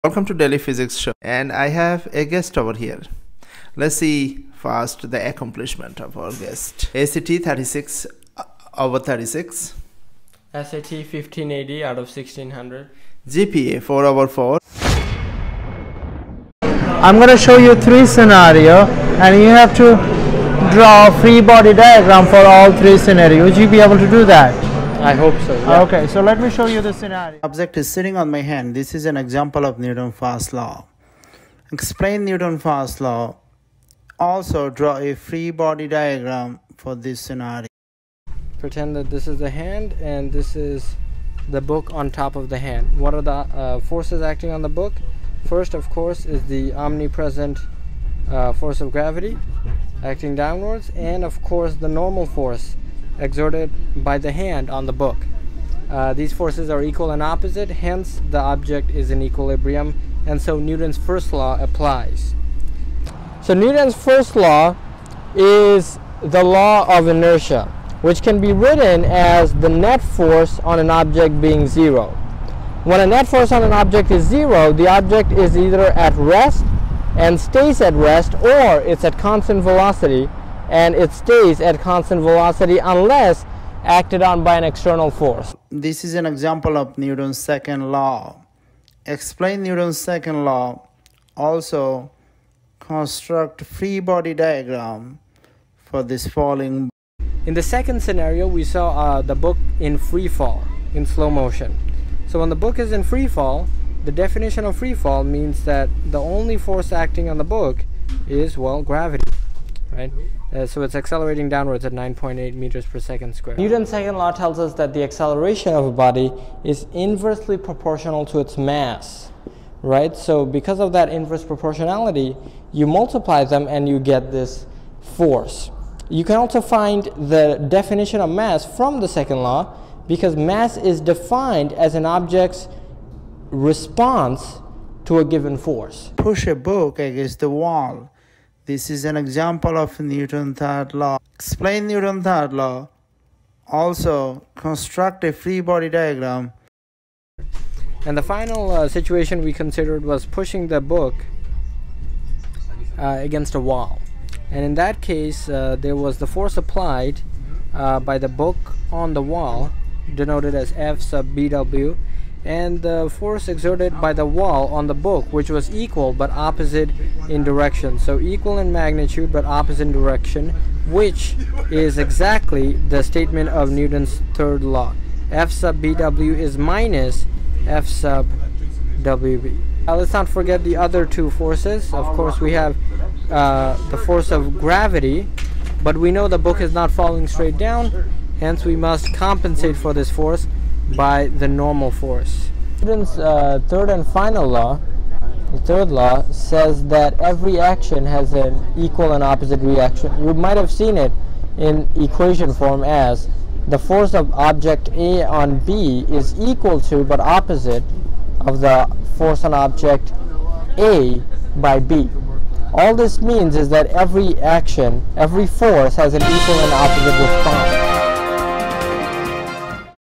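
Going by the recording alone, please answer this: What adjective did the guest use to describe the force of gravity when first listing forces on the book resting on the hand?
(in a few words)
omnipresent.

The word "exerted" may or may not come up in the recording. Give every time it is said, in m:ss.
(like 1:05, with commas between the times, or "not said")
0:53, 2:43.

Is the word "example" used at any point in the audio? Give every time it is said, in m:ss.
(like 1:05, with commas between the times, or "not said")
0:29, 1:26, 2:19.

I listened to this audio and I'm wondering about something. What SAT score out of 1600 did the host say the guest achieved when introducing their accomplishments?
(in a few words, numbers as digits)
1580.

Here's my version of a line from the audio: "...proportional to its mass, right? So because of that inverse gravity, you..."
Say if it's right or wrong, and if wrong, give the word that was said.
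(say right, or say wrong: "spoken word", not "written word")
wrong: "proportionality", not "gravity".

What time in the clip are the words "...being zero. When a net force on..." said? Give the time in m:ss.
1:11.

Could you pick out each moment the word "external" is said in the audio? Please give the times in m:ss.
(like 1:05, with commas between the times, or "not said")
1:24.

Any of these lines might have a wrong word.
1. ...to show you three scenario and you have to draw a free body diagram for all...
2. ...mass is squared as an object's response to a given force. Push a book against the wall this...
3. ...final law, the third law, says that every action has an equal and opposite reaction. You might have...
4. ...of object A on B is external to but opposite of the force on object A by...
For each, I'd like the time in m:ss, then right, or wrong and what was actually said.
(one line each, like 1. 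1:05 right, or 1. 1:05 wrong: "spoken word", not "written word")
1. 0:17 right
2. 2:10 wrong: "defined", not "squared"
3. 3:14 right
4. 3:24 wrong: "equal", not "external".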